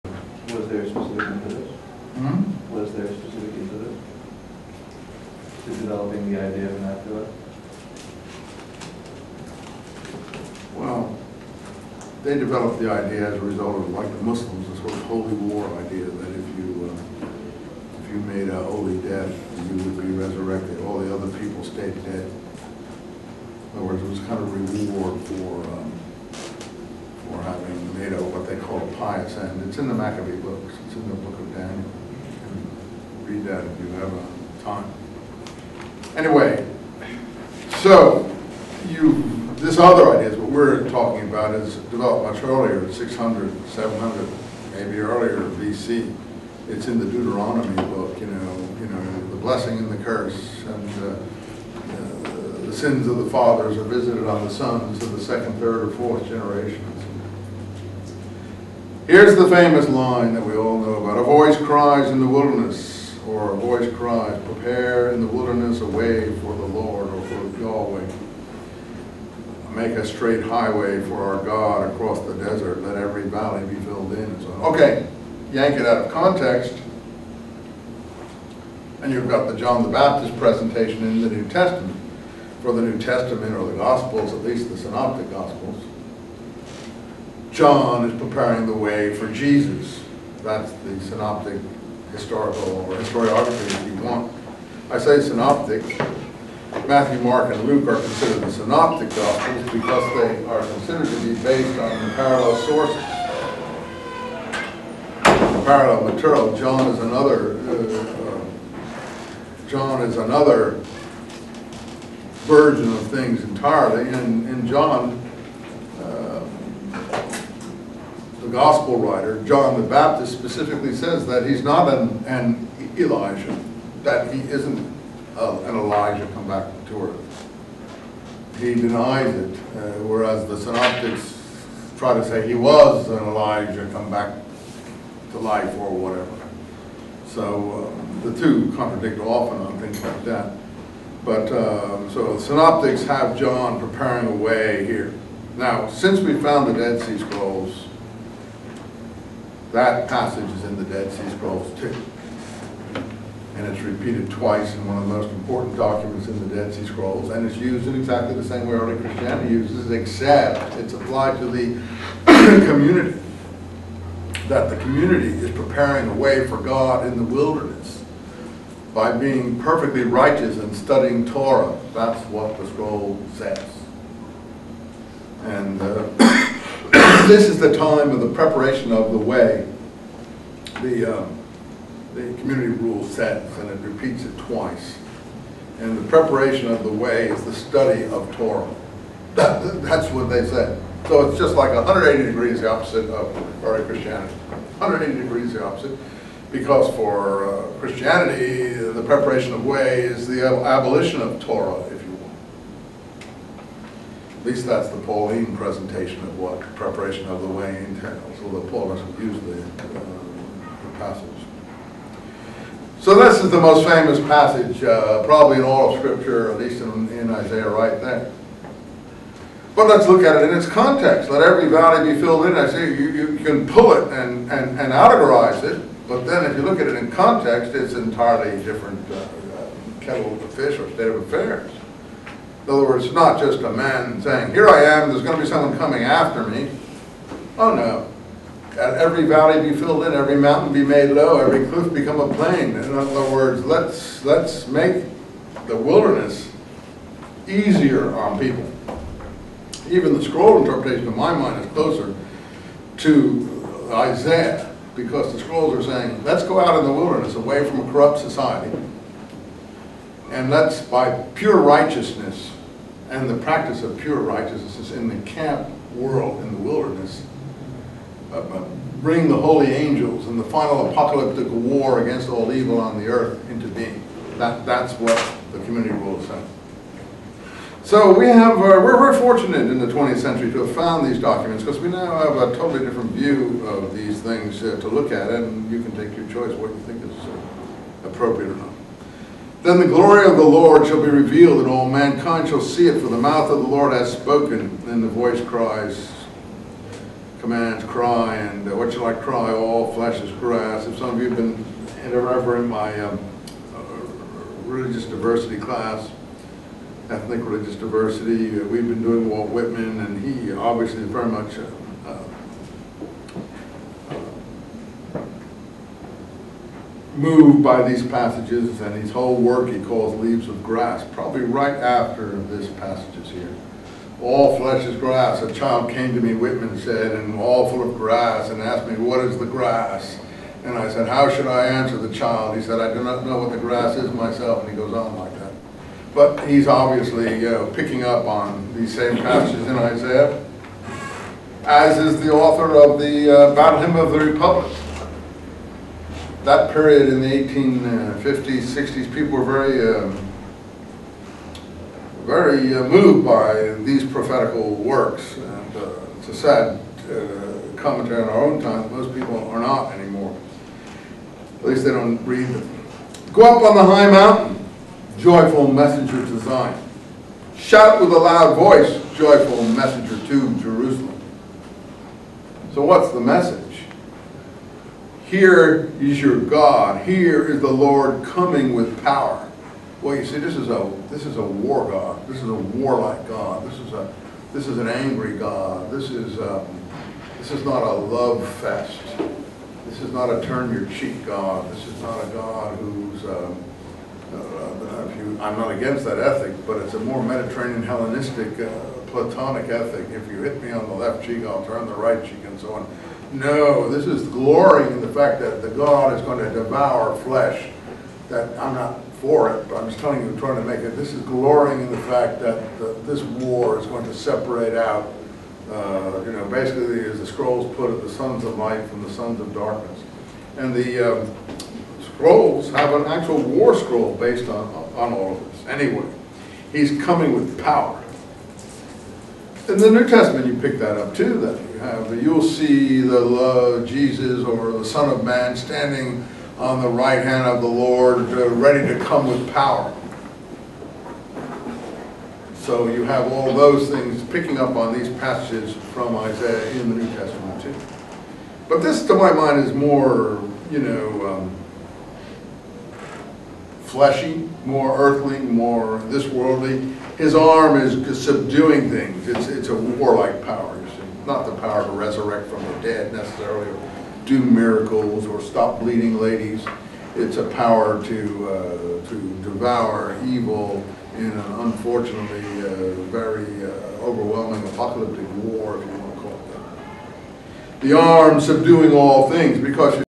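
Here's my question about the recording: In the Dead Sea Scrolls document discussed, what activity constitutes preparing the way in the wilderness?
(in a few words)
Study of Torah.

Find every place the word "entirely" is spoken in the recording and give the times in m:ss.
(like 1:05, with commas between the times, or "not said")
1:53, 3:47.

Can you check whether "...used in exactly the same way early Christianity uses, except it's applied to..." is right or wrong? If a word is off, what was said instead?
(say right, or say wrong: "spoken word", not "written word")
right.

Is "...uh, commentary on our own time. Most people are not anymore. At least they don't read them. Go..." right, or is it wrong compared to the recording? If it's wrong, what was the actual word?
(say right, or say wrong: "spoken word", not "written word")
right.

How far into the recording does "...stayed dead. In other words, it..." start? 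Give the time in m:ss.
0:21.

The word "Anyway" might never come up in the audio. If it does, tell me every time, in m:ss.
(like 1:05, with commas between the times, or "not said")
0:36, 7:05.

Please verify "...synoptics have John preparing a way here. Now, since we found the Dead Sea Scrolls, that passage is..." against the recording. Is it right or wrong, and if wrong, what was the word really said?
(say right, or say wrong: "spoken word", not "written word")
right.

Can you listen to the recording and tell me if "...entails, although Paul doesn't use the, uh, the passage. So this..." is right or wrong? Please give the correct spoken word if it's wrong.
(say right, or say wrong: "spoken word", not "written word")
right.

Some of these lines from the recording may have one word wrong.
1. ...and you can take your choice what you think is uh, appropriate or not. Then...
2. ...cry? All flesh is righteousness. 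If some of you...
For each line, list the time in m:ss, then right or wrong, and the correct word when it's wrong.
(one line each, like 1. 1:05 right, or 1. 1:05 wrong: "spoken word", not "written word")
1. 4:45 right
2. 4:59 wrong: "grass", not "righteousness".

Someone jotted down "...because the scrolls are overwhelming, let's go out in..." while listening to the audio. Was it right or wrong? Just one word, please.
wrong.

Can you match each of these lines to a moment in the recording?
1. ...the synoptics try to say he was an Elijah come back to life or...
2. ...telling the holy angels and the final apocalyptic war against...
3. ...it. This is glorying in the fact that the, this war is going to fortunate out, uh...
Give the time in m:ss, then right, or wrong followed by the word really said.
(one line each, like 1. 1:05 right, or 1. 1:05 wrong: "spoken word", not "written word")
1. 2:10 right
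2. 4:29 wrong: "bring", not "telling"
3. 6:50 wrong: "separate", not "fortunate".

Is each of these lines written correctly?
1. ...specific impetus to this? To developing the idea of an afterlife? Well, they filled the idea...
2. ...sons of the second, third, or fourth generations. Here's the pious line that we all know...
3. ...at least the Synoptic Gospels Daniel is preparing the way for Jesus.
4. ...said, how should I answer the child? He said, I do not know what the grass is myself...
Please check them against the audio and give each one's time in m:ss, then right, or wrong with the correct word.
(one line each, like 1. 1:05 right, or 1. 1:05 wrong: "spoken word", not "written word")
1. 0:03 wrong: "developed", not "filled"
2. 0:54 wrong: "famous", not "pious"
3. 1:24 wrong: "John", not "Daniel"
4. 5:30 right.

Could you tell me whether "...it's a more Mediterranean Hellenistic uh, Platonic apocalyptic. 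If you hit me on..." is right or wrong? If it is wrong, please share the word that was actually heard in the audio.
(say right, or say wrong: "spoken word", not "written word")
wrong: "ethic", not "apocalyptic".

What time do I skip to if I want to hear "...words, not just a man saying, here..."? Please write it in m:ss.
3:52.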